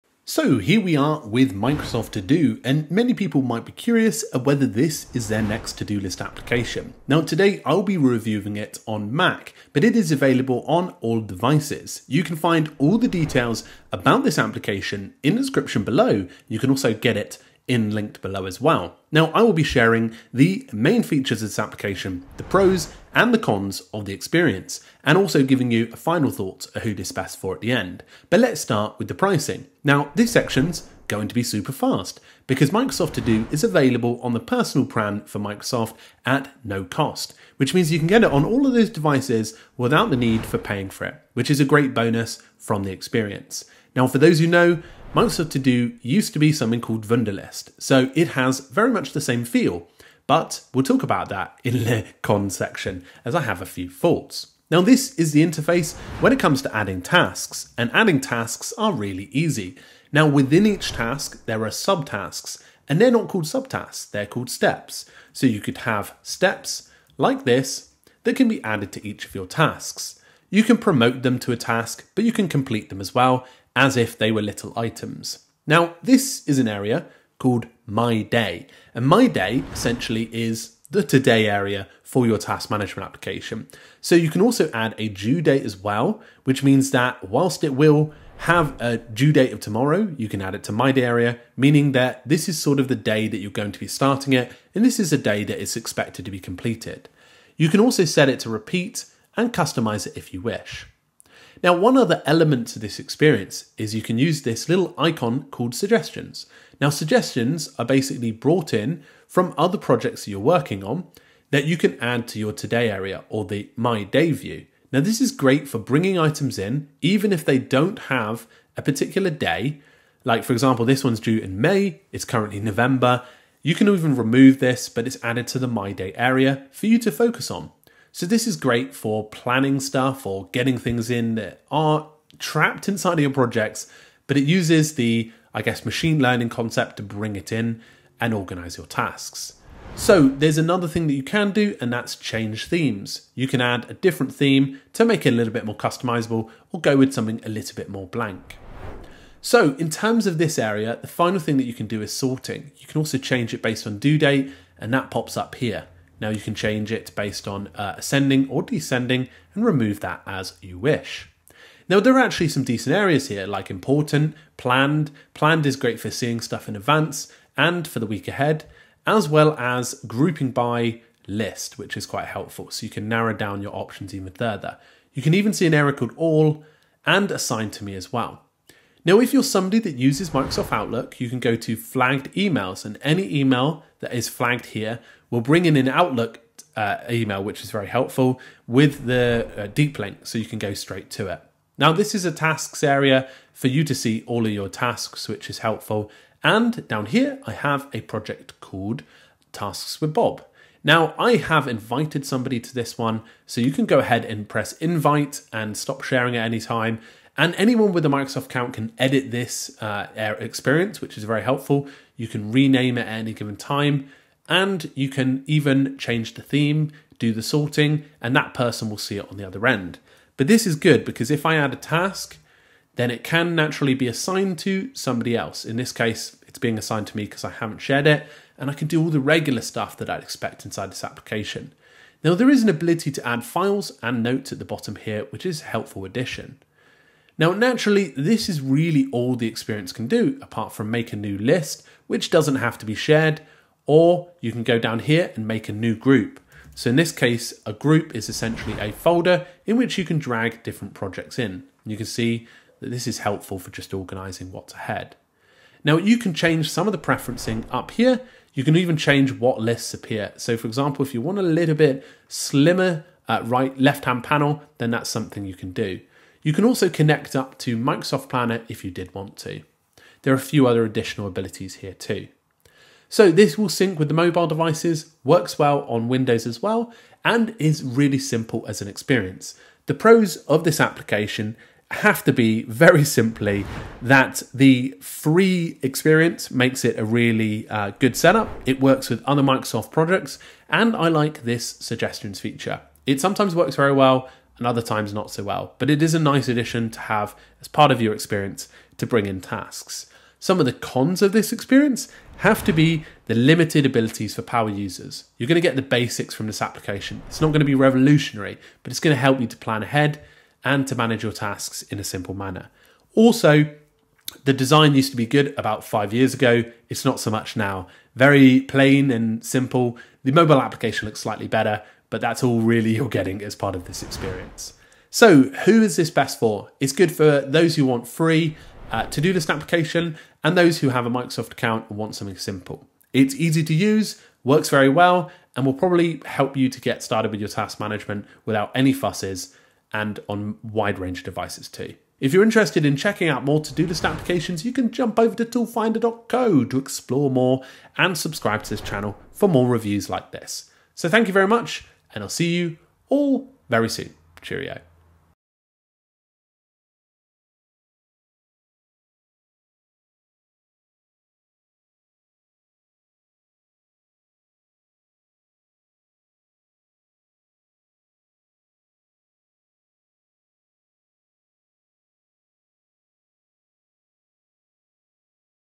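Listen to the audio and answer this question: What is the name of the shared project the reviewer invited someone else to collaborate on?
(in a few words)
Tasks with Bob.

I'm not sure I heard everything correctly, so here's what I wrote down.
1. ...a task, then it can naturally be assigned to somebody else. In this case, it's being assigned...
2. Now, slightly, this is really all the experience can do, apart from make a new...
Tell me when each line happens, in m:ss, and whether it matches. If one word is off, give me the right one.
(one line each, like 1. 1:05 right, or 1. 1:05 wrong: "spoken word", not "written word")
1. 3:41 right
2. 3:57 wrong: "naturally", not "slightly".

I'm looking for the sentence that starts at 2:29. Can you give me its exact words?
So in terms of this area, the final thing that you can do is sorting.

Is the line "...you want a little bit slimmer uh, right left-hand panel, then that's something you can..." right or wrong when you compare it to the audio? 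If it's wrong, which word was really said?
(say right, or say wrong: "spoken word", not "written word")
right.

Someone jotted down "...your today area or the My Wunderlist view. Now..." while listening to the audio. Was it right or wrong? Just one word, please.
wrong.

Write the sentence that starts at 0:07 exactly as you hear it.
Now today I'll be reviewing it on Mac, but it is available on all devices.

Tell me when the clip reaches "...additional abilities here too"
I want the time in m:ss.
4:30.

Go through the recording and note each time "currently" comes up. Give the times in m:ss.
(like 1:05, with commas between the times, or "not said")
2:02.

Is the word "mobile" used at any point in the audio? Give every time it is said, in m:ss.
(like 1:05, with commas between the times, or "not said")
4:34, 5:20.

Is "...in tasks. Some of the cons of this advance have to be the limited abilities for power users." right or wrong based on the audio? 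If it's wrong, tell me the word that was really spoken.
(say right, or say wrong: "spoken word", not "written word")
wrong: "experience", not "advance".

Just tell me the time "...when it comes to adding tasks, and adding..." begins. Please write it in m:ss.
0:56.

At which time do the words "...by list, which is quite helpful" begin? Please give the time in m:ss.
2:50.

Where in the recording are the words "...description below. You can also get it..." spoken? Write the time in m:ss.
0:15.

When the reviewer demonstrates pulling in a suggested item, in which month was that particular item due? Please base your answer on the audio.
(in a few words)
May.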